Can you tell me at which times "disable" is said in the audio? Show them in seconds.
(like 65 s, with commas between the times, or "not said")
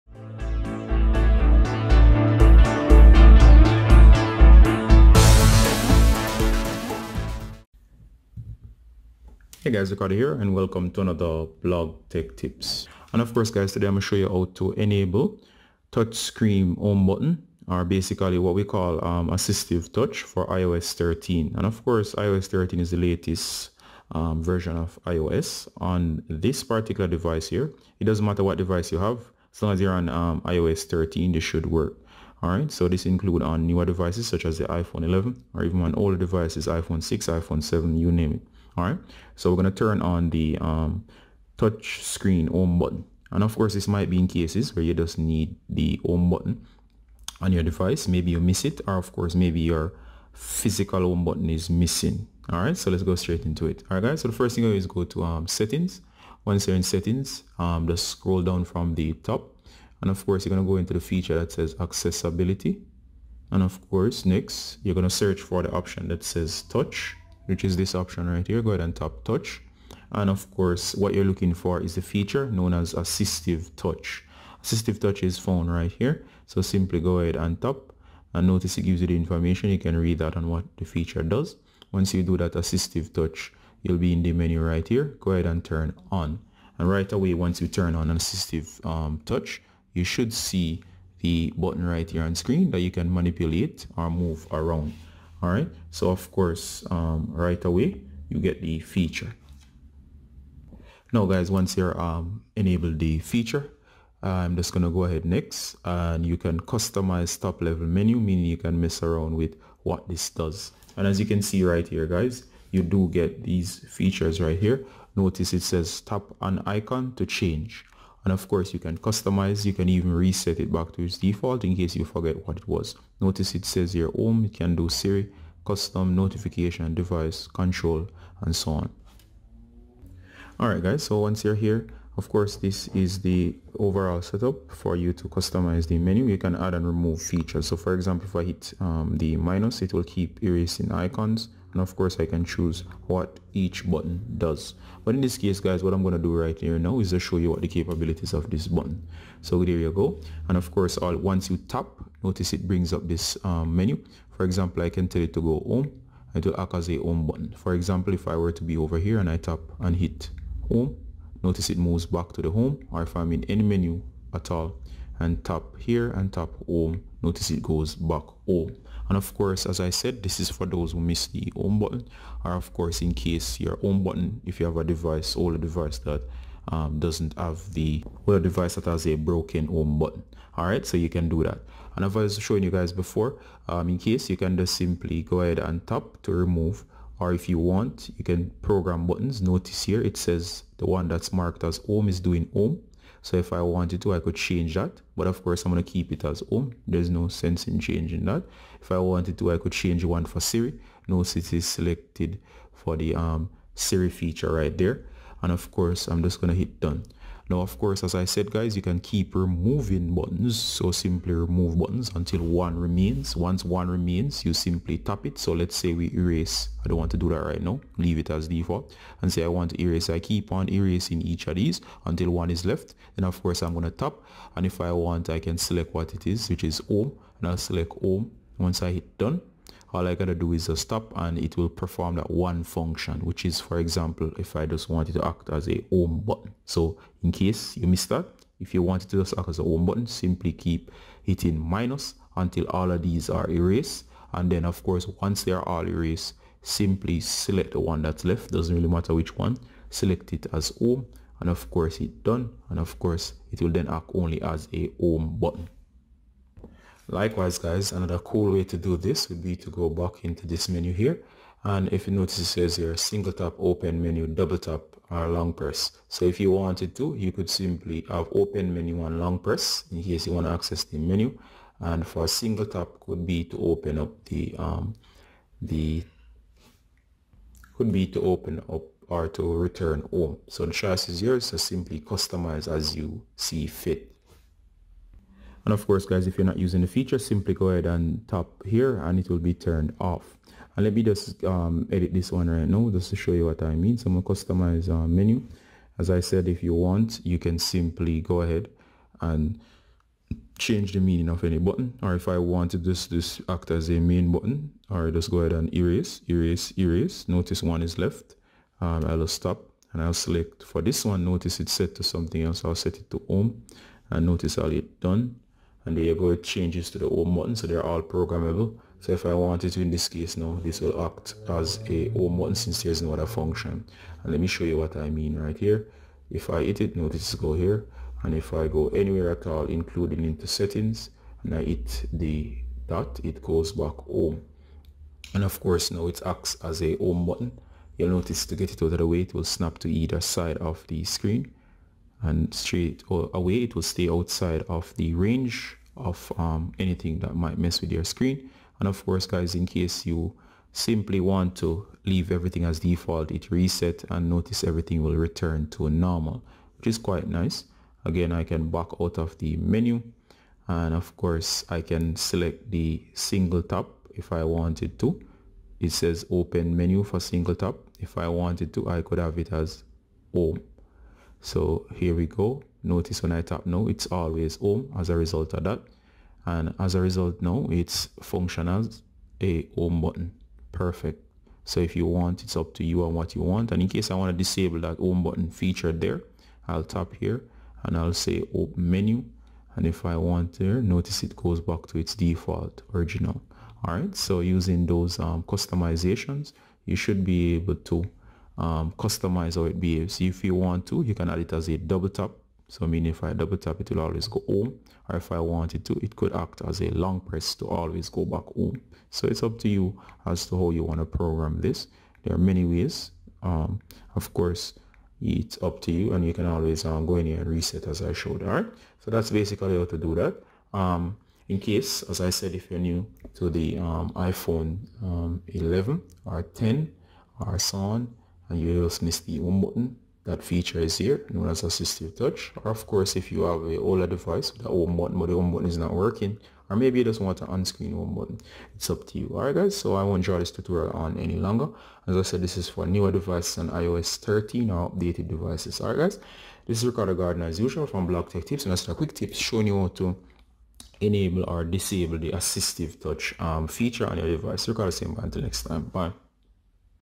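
384 s, 451 s.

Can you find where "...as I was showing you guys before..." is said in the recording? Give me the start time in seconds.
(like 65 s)
182 s.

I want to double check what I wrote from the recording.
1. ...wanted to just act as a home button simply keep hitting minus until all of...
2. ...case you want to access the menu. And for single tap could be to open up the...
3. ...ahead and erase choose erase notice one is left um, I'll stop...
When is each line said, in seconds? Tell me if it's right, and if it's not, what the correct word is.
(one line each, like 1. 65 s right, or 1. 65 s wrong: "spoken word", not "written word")
1. 238 s right
2. 270 s right
3. 305 s wrong: "erase", not "choose".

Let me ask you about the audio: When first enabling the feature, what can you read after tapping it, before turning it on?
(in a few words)
the information.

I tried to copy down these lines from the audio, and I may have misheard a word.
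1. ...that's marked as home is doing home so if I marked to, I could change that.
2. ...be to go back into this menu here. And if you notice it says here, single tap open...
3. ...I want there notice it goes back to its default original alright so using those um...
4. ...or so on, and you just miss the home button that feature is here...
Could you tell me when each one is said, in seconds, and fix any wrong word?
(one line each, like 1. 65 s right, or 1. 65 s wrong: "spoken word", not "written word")
1. 191 s wrong: "wanted", not "marked"
2. 259 s right
3. 390 s right
4. 427 s right.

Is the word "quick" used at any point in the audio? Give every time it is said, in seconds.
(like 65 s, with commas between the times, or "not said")
448 s.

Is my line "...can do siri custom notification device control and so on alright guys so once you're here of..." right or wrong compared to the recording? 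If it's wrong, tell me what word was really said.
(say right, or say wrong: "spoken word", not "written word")
right.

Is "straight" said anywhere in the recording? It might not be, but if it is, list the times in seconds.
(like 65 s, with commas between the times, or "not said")
53 s, 342 s.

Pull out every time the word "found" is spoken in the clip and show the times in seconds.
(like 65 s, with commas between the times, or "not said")
75 s.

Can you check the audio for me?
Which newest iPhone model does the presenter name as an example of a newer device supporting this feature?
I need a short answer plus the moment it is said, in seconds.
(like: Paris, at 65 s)
iPhone 11, at 34 s.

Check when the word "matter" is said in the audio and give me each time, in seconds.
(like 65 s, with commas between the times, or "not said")
28 s, 248 s.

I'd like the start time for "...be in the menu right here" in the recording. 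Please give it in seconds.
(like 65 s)
83 s.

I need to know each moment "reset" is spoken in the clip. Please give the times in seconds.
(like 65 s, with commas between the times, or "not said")
120 s, 353 s, 417 s.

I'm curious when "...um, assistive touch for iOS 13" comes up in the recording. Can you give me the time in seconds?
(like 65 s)
19 s.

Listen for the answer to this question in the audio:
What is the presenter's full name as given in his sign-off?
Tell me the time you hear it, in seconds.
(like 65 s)
446 s.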